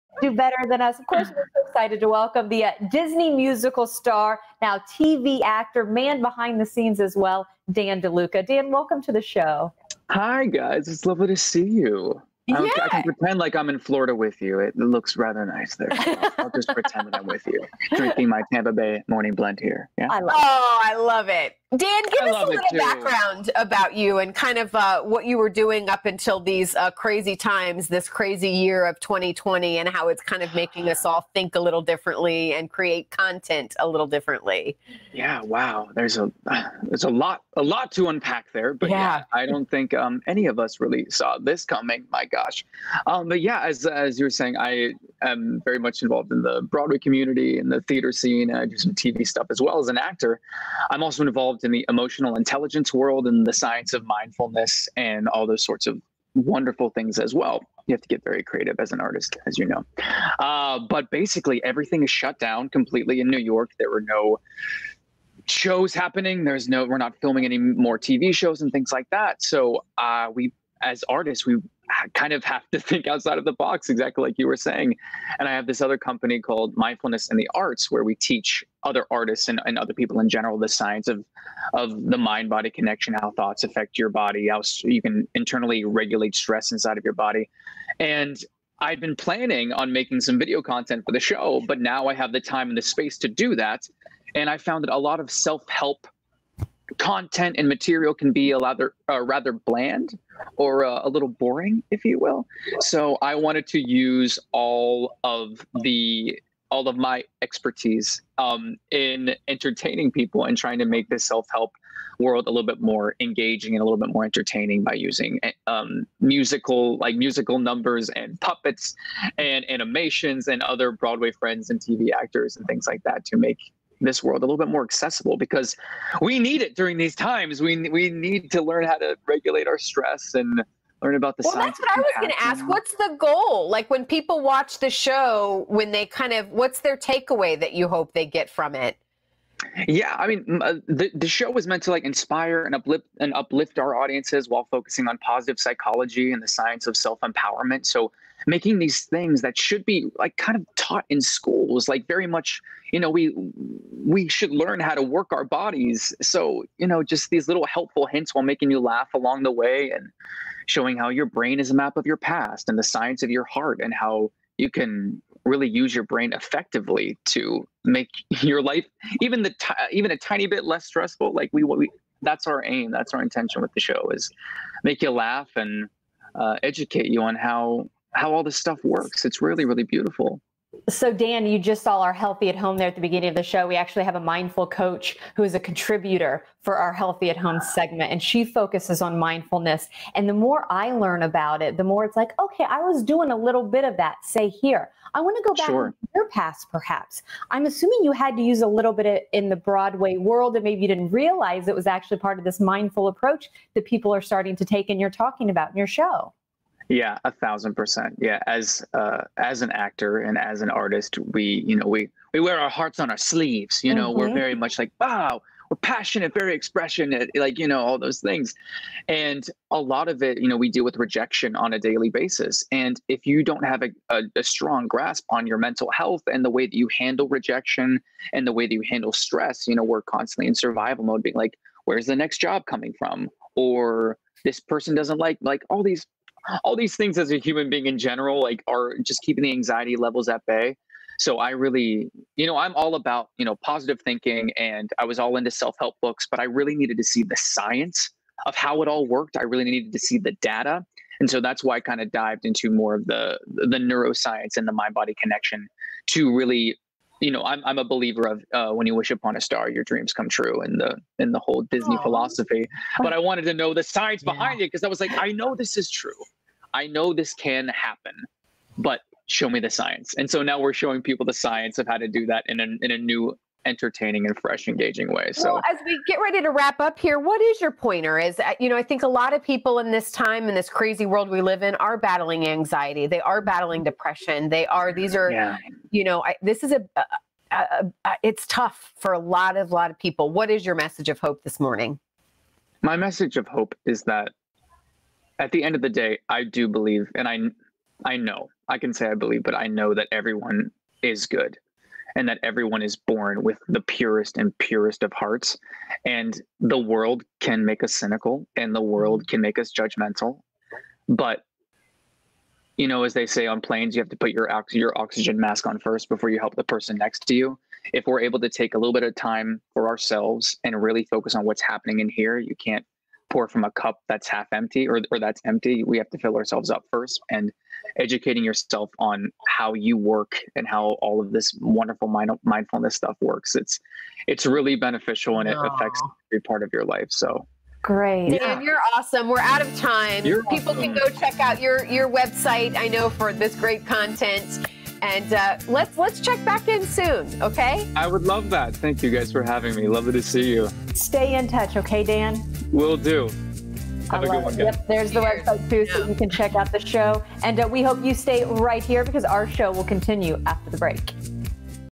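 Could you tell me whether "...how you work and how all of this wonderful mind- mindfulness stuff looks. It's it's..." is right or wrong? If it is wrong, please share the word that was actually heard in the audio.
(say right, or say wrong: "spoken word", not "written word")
wrong: "works", not "looks".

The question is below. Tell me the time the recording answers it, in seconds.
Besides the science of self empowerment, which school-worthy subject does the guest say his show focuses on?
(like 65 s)
145 s.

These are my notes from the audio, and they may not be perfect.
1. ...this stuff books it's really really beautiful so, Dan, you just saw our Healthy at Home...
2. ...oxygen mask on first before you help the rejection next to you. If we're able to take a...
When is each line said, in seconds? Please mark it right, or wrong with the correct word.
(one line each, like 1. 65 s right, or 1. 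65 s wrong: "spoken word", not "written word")
1. 178 s wrong: "works", not "books"
2. 314 s wrong: "person", not "rejection".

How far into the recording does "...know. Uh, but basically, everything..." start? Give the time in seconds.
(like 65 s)
59 s.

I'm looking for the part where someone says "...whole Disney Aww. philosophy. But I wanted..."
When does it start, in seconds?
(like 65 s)
261 s.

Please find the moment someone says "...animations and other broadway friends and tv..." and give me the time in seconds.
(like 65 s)
119 s.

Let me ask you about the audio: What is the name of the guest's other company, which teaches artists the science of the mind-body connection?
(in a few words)
Mindfulness in the Arts.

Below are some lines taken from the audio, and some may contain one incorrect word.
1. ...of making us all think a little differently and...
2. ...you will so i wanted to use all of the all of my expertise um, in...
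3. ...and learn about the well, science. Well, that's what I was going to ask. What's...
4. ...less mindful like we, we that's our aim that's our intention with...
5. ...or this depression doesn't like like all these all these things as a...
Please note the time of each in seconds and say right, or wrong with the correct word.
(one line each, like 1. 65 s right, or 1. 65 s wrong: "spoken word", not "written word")
1. 30 s right
2. 102 s right
3. 130 s right
4. 170 s wrong: "stressful", not "mindful"
5. 233 s wrong: "person", not "depression".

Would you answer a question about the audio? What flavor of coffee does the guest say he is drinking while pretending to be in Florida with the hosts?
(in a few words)
Tampa Bay morning blend.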